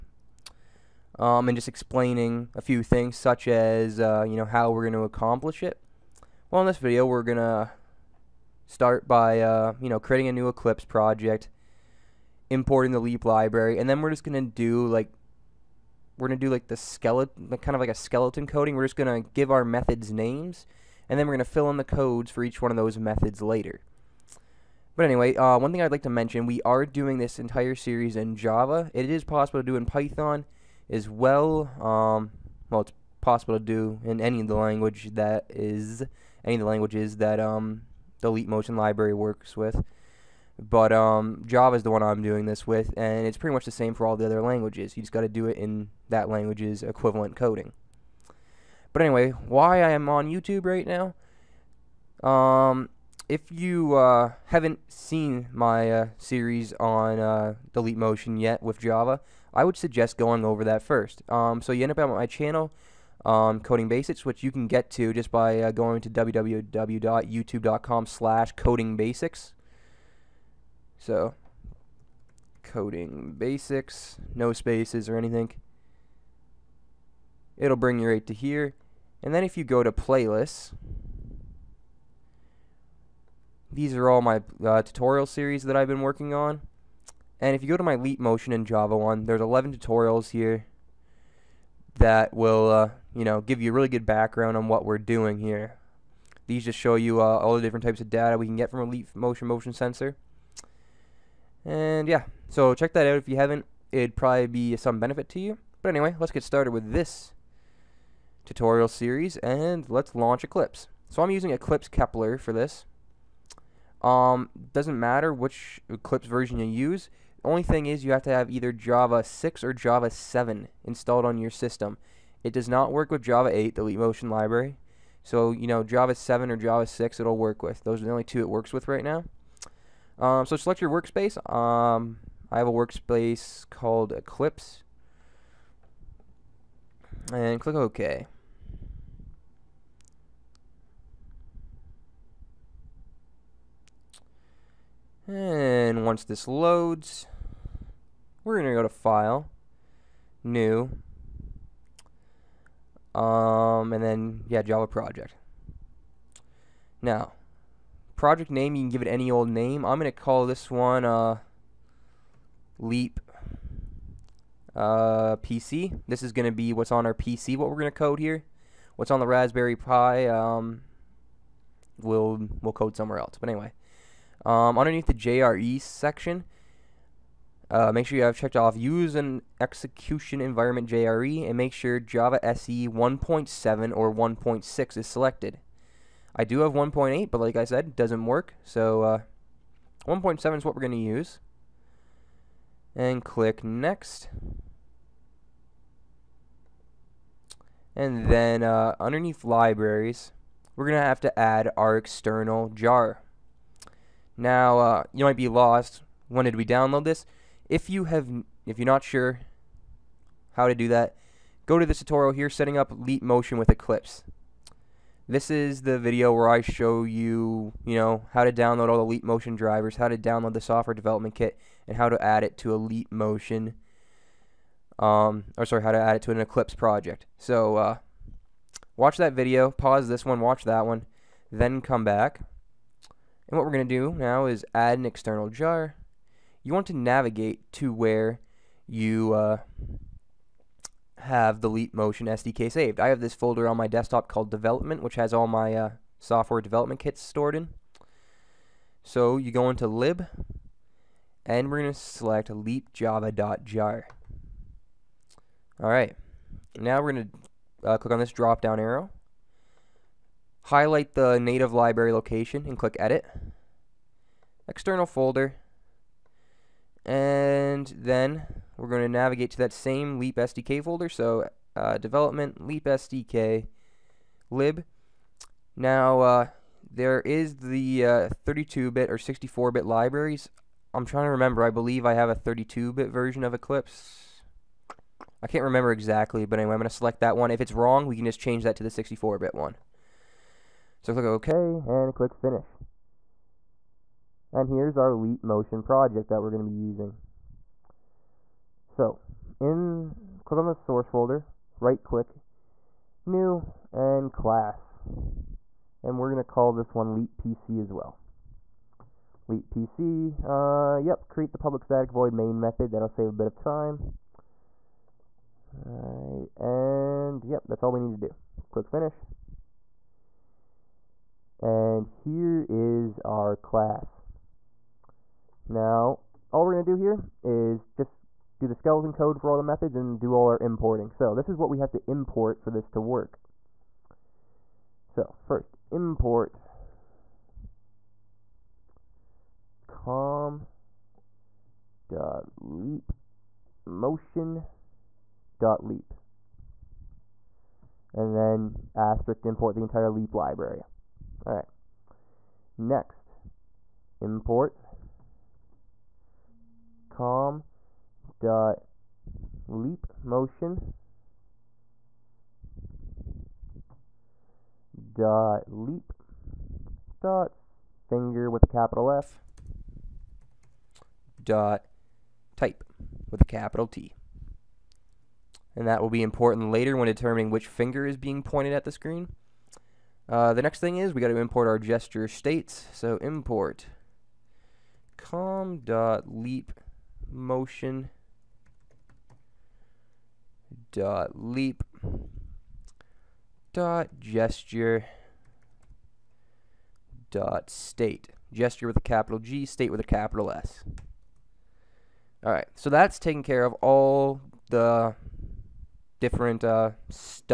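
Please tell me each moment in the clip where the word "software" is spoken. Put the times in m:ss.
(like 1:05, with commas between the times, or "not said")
3:40, 4:06.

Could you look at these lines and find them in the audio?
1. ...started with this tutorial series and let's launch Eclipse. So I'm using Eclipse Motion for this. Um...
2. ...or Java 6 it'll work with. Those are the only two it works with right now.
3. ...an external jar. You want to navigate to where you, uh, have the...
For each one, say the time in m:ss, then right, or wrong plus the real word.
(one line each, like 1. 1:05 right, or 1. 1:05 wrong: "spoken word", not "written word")
1. 1:46 wrong: "Kepler", not "Motion"
2. 2:06 right
3. 3:54 right.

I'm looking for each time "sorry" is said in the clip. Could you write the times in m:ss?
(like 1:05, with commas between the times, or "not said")
3:45.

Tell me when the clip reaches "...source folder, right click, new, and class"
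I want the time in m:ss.
5:00.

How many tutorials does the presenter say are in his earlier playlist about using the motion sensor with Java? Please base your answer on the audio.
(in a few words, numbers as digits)
11.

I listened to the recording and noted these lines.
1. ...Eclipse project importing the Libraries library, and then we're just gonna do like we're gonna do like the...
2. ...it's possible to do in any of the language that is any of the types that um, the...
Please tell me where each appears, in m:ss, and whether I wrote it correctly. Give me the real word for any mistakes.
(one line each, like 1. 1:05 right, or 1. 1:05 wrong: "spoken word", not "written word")
1. 0:10 wrong: "Leap", not "Libraries"
2. 0:32 wrong: "languages", not "types".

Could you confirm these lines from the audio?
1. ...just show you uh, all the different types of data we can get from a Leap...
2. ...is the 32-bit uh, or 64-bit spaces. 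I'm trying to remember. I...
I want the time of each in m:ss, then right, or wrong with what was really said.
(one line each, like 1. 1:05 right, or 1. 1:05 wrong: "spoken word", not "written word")
1. 1:36 right
2. 4:37 wrong: "libraries", not "spaces".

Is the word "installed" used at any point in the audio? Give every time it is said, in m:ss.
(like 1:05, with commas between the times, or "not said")
2:00.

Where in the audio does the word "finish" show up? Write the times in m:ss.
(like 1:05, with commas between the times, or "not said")
4:52, 5:18.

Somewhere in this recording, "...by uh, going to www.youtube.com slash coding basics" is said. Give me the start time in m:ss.
1:05.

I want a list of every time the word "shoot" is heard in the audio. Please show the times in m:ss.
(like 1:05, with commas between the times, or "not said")
not said.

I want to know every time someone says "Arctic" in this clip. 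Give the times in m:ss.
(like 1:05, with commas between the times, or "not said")
not said.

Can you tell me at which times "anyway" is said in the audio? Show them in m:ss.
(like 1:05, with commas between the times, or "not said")
0:25, 0:49, 1:45, 2:53, 4:46.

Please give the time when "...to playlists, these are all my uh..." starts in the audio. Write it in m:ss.
1:19.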